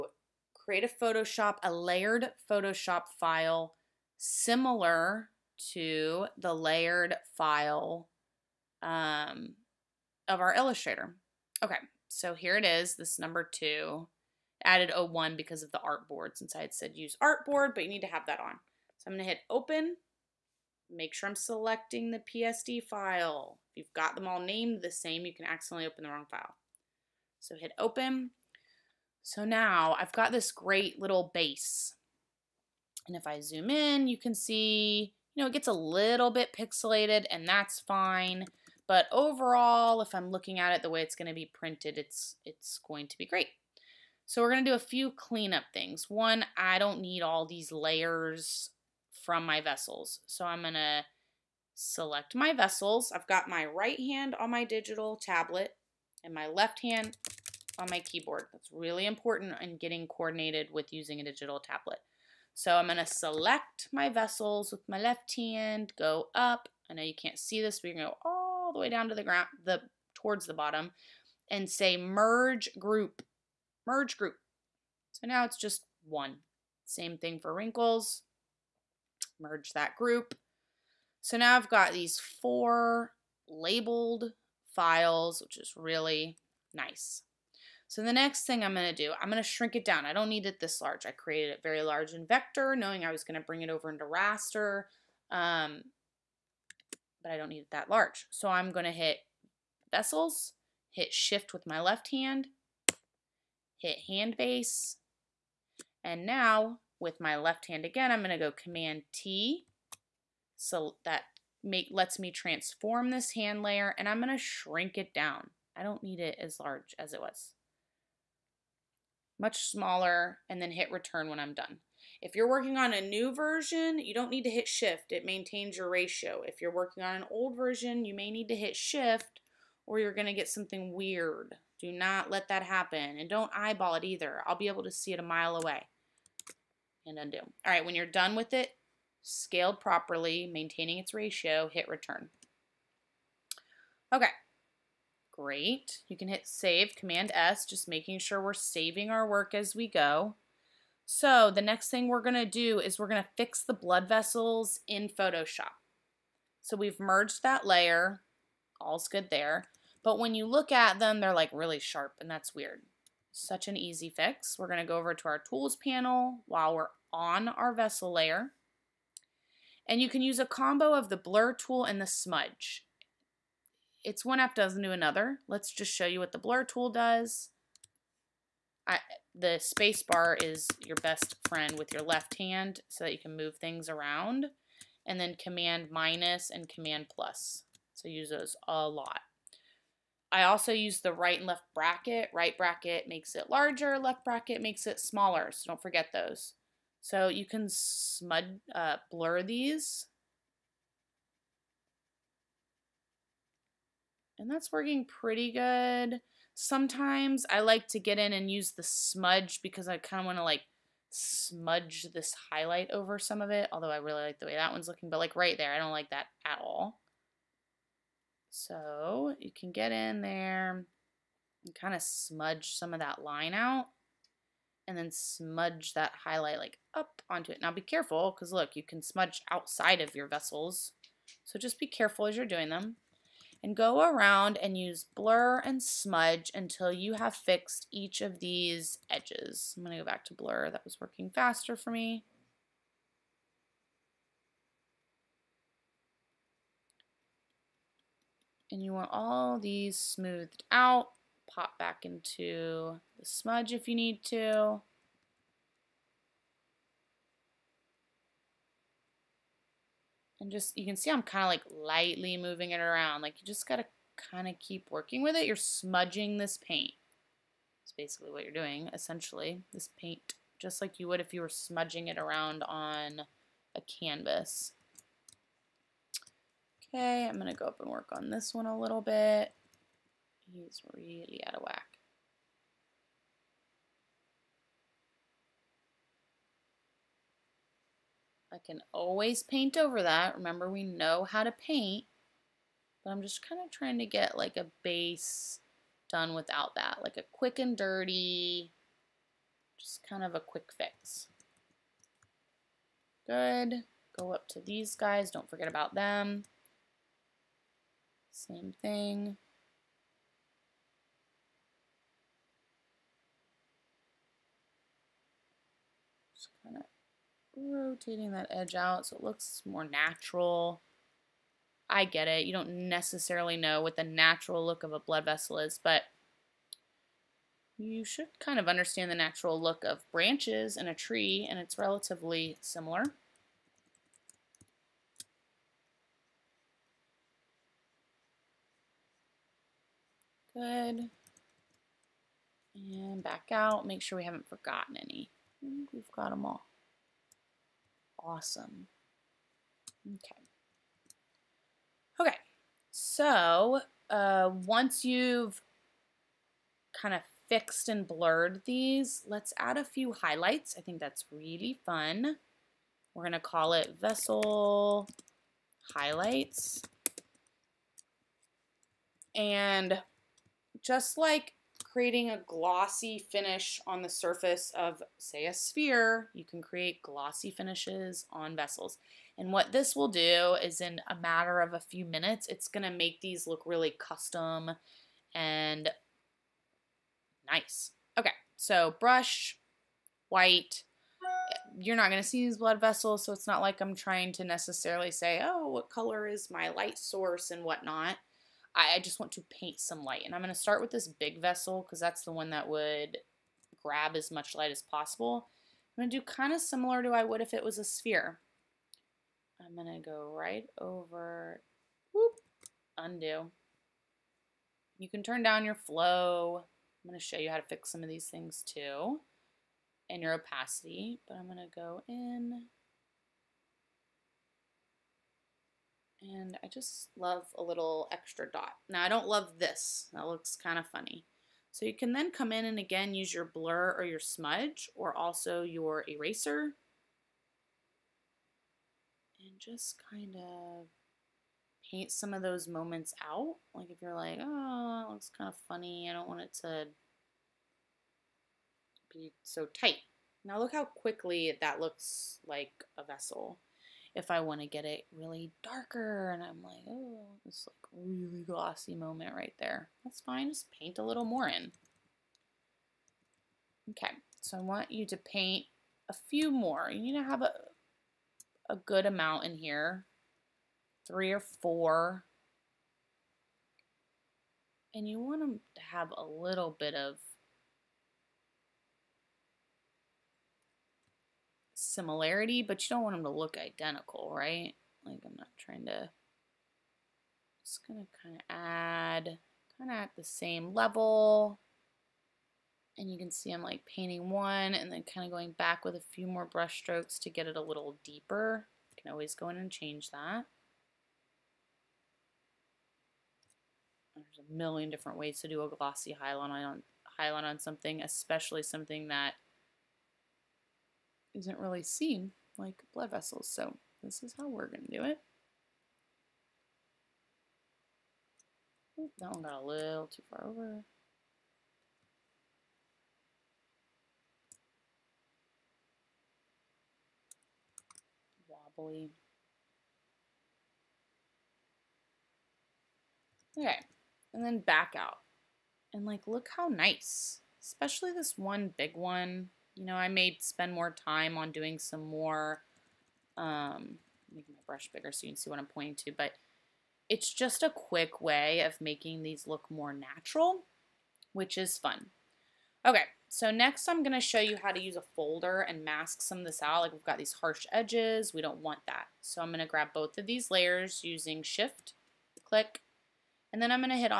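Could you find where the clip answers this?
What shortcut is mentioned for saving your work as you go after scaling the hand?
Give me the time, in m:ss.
2:26.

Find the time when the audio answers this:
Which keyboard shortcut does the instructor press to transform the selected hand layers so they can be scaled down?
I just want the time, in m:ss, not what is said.
1:48.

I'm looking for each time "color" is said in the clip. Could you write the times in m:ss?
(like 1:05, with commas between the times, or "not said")
6:35.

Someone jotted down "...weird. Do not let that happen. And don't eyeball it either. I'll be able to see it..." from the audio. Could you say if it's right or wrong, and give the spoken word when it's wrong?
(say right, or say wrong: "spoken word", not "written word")
right.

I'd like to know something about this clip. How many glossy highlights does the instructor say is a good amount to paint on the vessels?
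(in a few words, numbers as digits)
three or four.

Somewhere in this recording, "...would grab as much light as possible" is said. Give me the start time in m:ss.
6:42.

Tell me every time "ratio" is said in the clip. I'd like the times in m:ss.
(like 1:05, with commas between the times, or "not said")
2:05, 2:21.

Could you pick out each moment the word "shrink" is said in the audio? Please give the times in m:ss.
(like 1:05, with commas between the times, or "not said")
1:29, 1:54.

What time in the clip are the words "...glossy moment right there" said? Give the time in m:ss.
7:38.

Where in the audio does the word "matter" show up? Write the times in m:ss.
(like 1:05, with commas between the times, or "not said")
6:21.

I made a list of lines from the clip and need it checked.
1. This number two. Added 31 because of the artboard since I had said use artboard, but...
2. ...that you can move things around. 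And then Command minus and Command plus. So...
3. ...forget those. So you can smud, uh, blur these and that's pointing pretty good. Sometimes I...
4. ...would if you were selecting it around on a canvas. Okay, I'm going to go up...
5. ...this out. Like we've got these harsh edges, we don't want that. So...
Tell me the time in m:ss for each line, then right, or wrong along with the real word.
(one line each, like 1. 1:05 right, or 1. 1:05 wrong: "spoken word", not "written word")
1. 0:12 wrong: "01", not "31"
2. 3:03 right
3. 3:15 wrong: "working", not "pointing"
4. 4:31 wrong: "smudging", not "selecting"
5. 9:16 right.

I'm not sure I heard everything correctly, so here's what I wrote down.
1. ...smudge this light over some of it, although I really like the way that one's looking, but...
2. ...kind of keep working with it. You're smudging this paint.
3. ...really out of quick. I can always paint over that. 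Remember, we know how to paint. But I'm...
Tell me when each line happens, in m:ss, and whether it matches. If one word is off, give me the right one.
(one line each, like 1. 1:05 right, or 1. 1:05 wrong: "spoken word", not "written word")
1. 3:31 wrong: "highlight", not "light"
2. 4:24 right
3. 4:40 wrong: "whack", not "quick".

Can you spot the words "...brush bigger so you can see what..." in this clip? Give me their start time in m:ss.
9:04.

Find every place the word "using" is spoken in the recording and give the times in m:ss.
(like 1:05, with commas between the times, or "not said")
1:00, 9:21.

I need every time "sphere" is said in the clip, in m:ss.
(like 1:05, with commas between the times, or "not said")
6:15, 6:47.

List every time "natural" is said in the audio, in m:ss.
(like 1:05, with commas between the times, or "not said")
5:19, 5:24, 5:29, 9:09.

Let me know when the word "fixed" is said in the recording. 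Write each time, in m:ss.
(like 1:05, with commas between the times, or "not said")
3:57, 5:57.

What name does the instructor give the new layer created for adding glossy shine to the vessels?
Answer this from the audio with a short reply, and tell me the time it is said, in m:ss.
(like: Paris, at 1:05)
vessel highlights, at 6:04.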